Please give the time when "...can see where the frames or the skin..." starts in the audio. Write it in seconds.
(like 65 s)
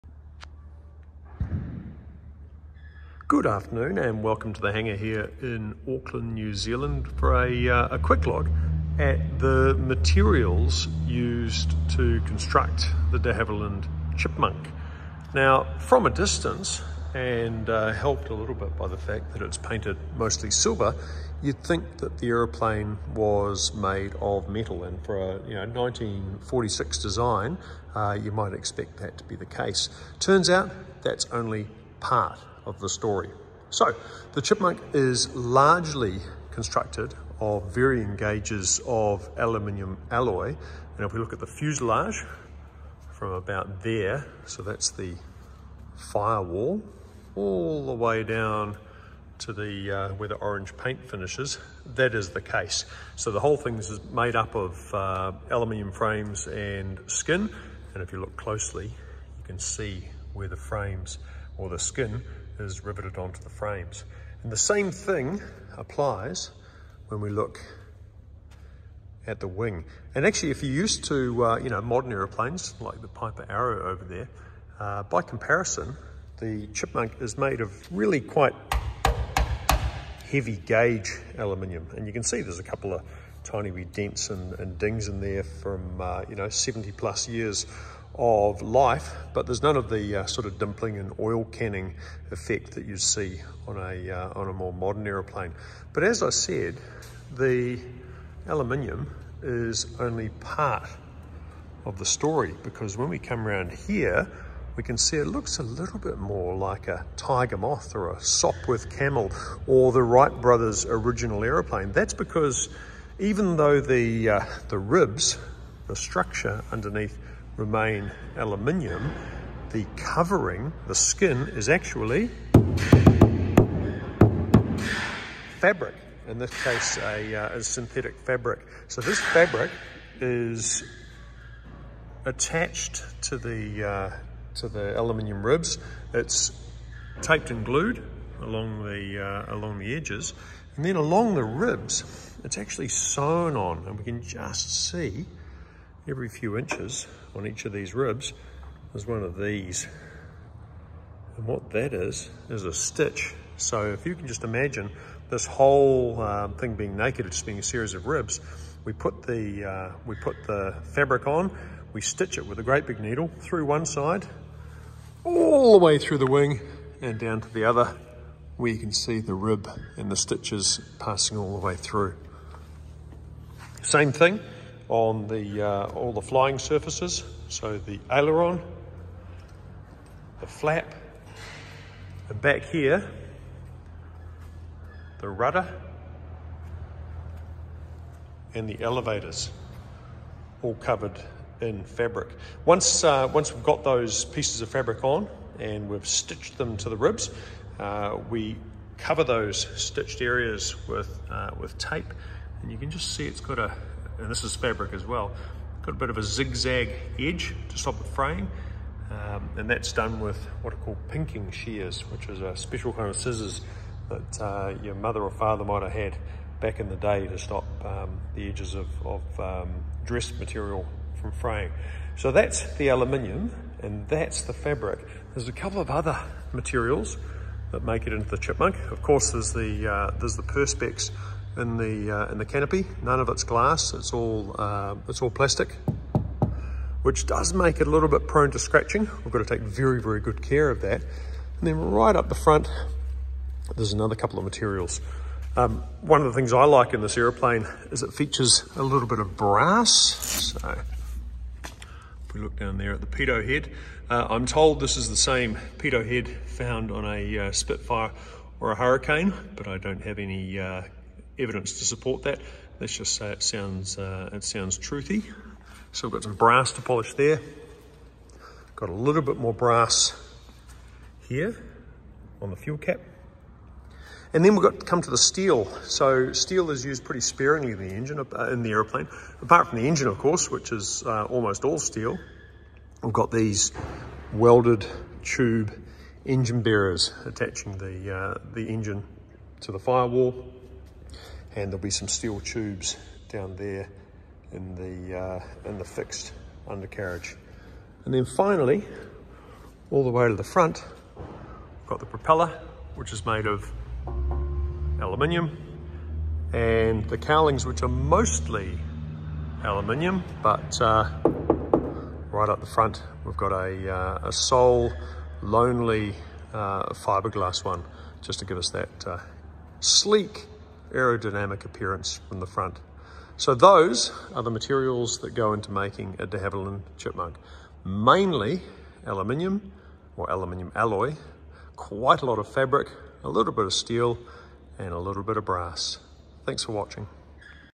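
59 s.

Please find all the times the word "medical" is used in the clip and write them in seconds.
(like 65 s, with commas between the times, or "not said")
not said.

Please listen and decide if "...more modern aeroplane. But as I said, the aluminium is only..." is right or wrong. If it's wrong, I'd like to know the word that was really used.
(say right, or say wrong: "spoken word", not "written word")
right.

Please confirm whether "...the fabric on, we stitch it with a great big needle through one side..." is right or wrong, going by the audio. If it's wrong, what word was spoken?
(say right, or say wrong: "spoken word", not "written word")
right.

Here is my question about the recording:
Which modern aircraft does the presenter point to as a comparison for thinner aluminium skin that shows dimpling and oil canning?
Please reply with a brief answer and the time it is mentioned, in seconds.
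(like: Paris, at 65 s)
Piper Arrow, at 73 s.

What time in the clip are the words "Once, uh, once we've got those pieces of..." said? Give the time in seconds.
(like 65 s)
192 s.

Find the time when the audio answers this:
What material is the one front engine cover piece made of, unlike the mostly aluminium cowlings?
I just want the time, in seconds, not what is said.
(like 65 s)
316 s.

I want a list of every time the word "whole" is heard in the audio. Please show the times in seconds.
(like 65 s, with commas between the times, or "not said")
53 s, 155 s.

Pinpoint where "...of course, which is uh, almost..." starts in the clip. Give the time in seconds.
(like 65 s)
280 s.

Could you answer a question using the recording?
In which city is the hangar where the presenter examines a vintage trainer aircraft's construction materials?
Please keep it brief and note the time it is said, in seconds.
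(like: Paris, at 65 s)
Auckland, at 5 s.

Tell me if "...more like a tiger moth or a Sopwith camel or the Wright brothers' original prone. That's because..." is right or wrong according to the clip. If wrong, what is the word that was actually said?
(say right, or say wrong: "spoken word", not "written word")
wrong: "aeroplane", not "prone".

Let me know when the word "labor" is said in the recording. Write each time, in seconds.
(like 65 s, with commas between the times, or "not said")
not said.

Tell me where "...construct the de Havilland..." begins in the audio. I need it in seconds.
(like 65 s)
12 s.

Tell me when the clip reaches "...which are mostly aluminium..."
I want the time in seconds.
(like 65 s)
307 s.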